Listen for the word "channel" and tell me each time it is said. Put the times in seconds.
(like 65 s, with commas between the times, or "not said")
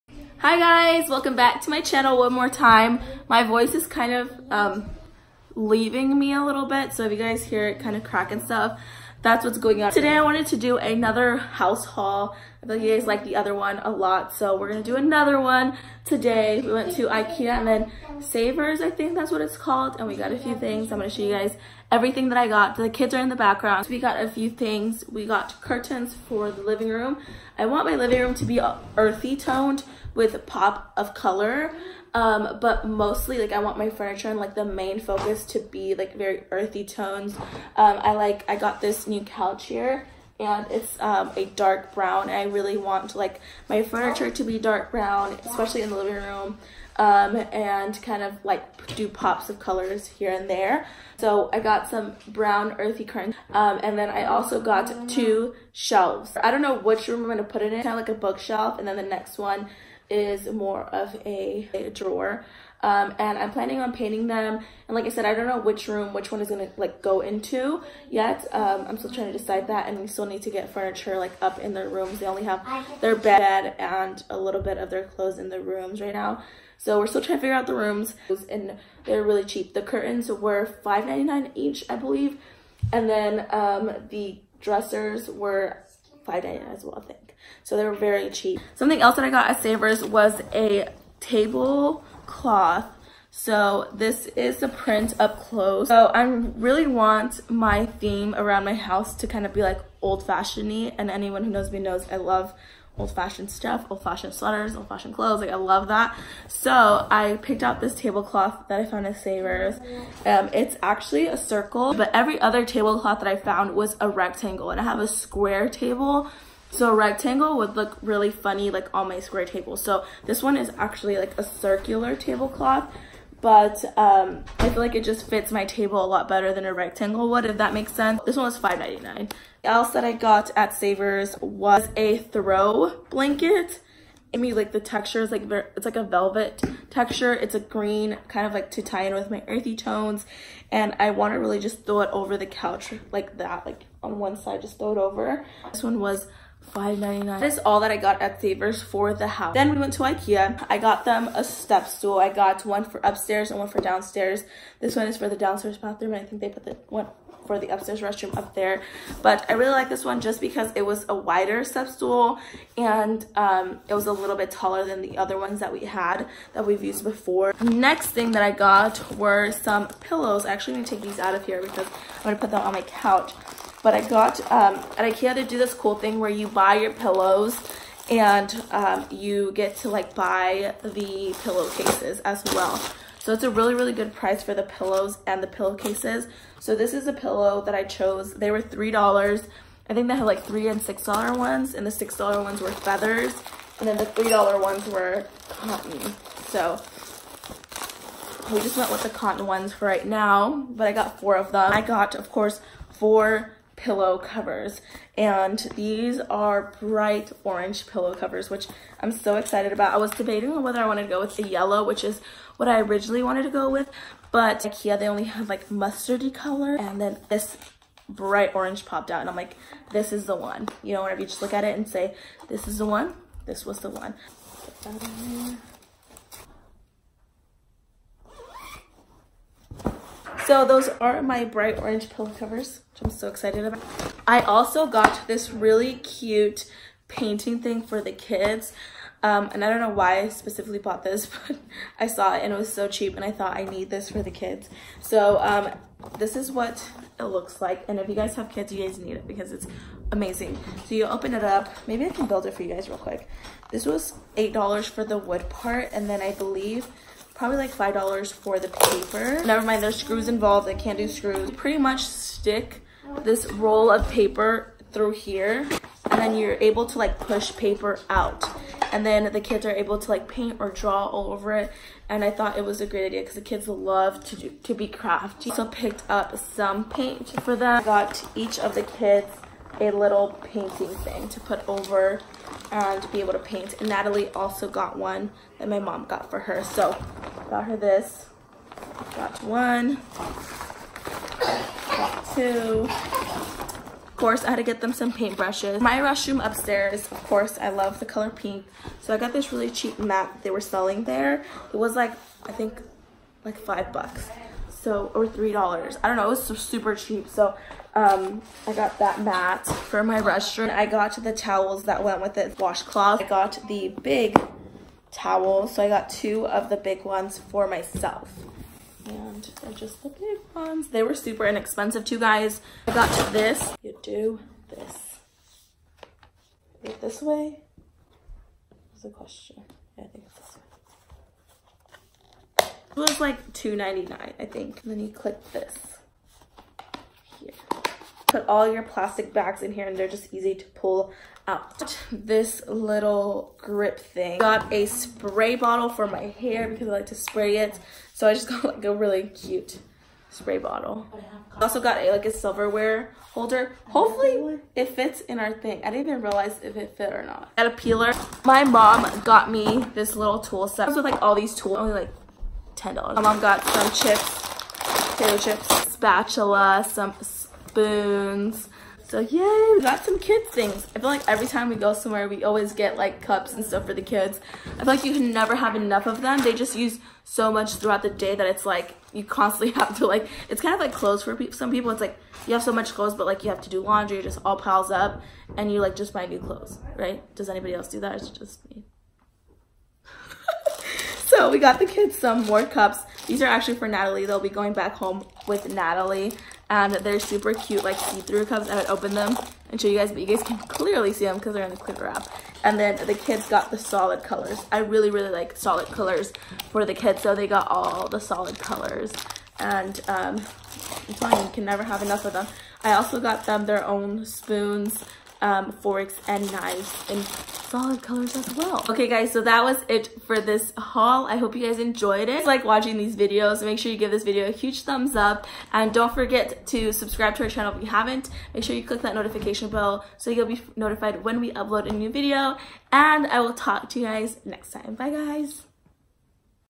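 1 s, 427 s.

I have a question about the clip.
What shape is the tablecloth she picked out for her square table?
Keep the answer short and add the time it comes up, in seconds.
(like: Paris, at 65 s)
circle, at 111 s.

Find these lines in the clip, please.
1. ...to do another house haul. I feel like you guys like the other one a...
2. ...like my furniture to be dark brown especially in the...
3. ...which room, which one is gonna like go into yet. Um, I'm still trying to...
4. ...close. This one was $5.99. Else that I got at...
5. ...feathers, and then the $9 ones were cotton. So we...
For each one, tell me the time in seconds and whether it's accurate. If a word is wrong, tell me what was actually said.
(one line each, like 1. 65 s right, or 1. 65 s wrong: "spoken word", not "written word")
1. 10 s right
2. 43 s right
3. 65 s right
4. 127 s wrong: "sense", not "close"
5. 192 s wrong: "3", not "9".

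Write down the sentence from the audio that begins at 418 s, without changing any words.
Okay guys, so that was it for this haul.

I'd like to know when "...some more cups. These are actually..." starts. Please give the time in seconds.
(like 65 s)
392 s.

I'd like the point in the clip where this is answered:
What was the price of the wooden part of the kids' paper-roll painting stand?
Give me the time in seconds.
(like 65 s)
254 s.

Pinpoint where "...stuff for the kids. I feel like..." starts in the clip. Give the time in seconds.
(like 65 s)
373 s.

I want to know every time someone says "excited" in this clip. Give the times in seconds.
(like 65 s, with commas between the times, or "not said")
209 s, 233 s.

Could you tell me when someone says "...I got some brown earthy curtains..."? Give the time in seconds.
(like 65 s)
51 s.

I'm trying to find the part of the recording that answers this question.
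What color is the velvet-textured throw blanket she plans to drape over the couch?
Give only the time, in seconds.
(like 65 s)
137 s.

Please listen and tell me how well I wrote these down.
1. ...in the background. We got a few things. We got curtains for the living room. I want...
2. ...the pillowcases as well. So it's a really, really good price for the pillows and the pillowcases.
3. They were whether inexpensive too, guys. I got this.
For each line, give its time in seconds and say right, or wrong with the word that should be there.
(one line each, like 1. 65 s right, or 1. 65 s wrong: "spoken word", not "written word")
1. 23 s right
2. 180 s right
3. 320 s wrong: "super", not "whether".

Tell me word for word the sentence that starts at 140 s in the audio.
And I want to really just throw it over the couch like that, like on one side, just throw it over.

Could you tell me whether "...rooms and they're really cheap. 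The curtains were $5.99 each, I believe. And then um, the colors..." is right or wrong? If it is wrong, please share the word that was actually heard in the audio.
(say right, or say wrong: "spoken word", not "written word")
wrong: "dressers", not "colors".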